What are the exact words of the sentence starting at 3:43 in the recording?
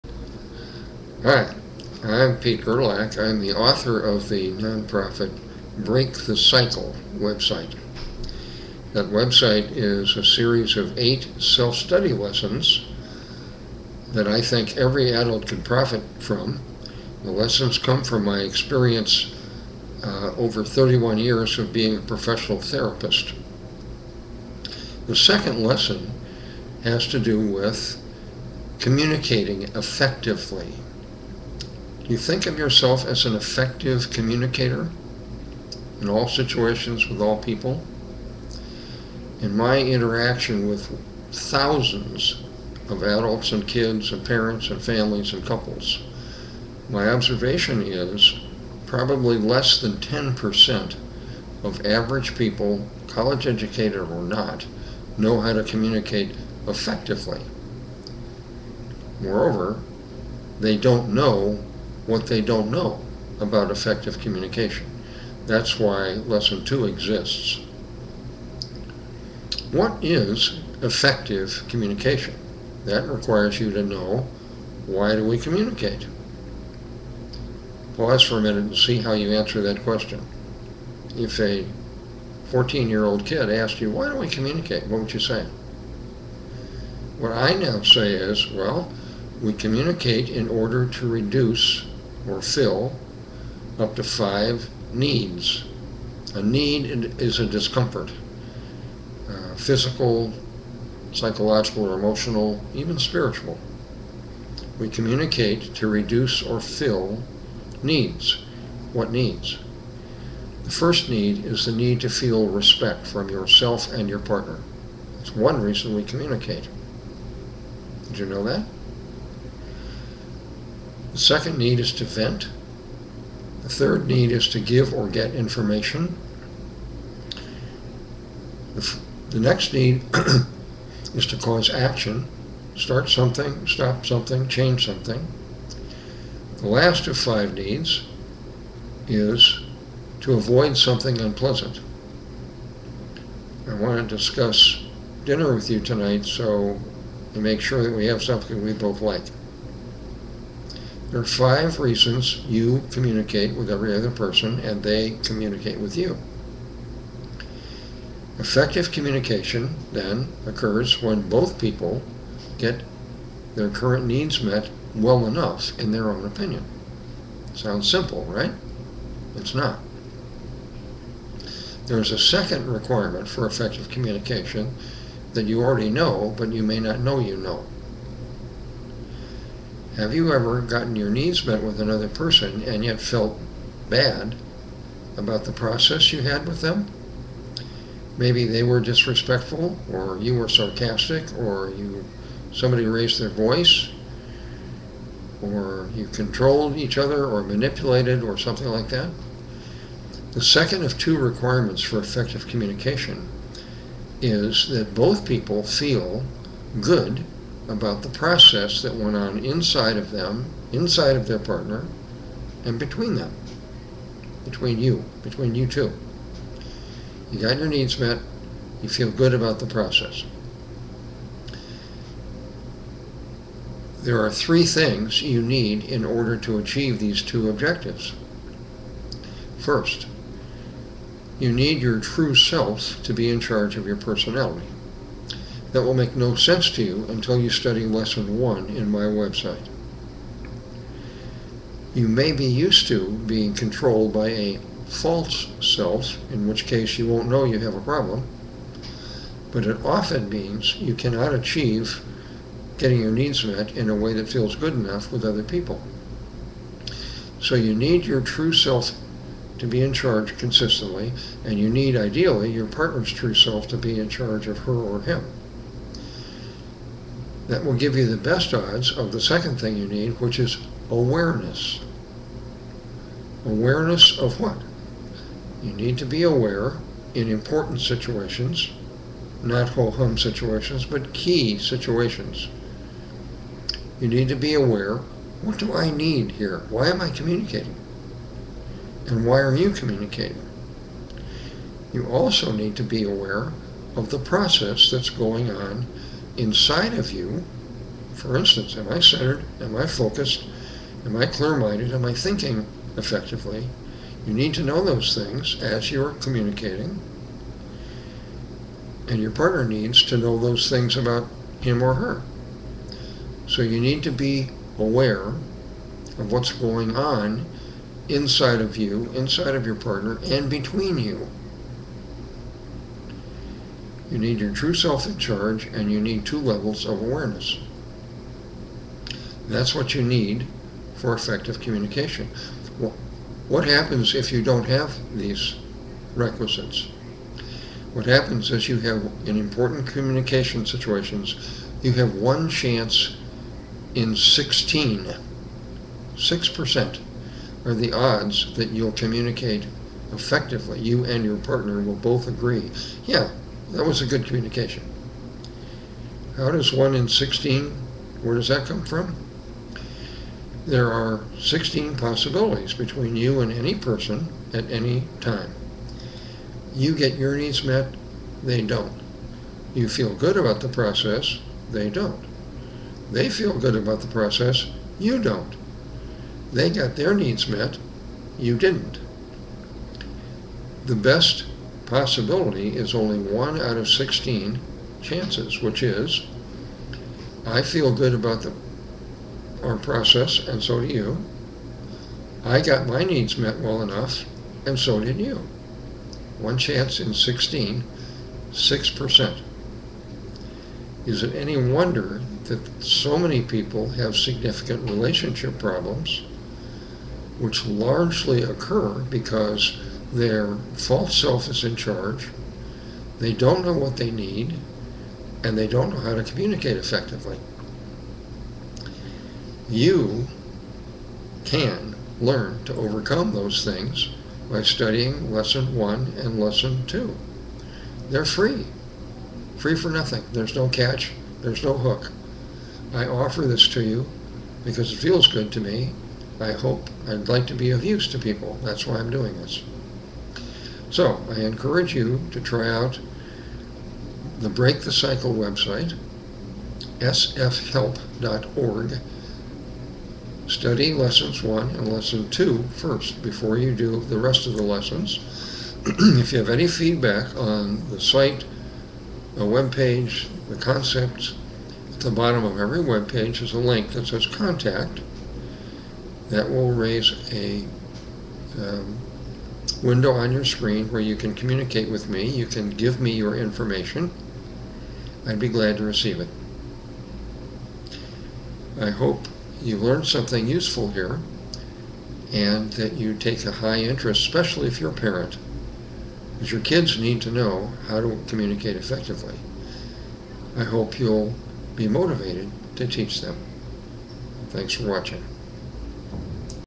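There are three things you need in order to achieve these two objectives.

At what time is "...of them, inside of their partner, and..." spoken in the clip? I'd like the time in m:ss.
3:29.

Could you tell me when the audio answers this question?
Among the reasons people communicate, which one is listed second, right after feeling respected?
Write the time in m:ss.
2:01.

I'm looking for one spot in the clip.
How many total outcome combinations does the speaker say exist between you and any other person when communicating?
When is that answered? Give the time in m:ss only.
6:01.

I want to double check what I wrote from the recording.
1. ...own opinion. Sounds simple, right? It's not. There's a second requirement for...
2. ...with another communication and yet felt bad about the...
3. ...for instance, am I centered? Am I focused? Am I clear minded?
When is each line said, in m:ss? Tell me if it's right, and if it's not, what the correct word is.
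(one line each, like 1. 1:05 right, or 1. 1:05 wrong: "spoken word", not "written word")
1. 2:46 right
2. 3:01 wrong: "person", not "communication"
3. 4:58 right.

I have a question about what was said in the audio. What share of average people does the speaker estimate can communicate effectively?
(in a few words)
less than 10%.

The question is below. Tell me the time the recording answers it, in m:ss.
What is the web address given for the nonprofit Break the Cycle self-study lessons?
7:26.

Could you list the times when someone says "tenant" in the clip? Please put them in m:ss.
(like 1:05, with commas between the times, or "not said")
not said.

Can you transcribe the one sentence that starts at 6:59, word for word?
You can learn to overcome those things by studying lesson one and lesson two.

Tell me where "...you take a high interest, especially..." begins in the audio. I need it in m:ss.
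8:02.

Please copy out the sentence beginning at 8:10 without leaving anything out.
I hope you'll be motivated to teach them.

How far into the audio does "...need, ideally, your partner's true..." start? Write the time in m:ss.
4:21.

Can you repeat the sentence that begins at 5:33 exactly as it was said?
What happens if you don't have these requisites?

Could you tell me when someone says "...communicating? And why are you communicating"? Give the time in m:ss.
4:47.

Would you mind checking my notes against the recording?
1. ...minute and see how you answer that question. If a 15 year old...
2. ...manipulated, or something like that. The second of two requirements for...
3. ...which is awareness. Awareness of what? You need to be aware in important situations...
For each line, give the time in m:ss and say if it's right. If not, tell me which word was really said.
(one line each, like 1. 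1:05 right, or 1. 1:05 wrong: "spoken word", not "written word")
1. 1:18 wrong: "14", not "15"
2. 3:17 right
3. 4:30 right.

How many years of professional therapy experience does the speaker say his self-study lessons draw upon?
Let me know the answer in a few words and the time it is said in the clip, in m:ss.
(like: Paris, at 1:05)
31, at 0:20.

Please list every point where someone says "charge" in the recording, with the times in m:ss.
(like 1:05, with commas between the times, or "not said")
3:53, 4:19, 4:24, 5:25, 6:51.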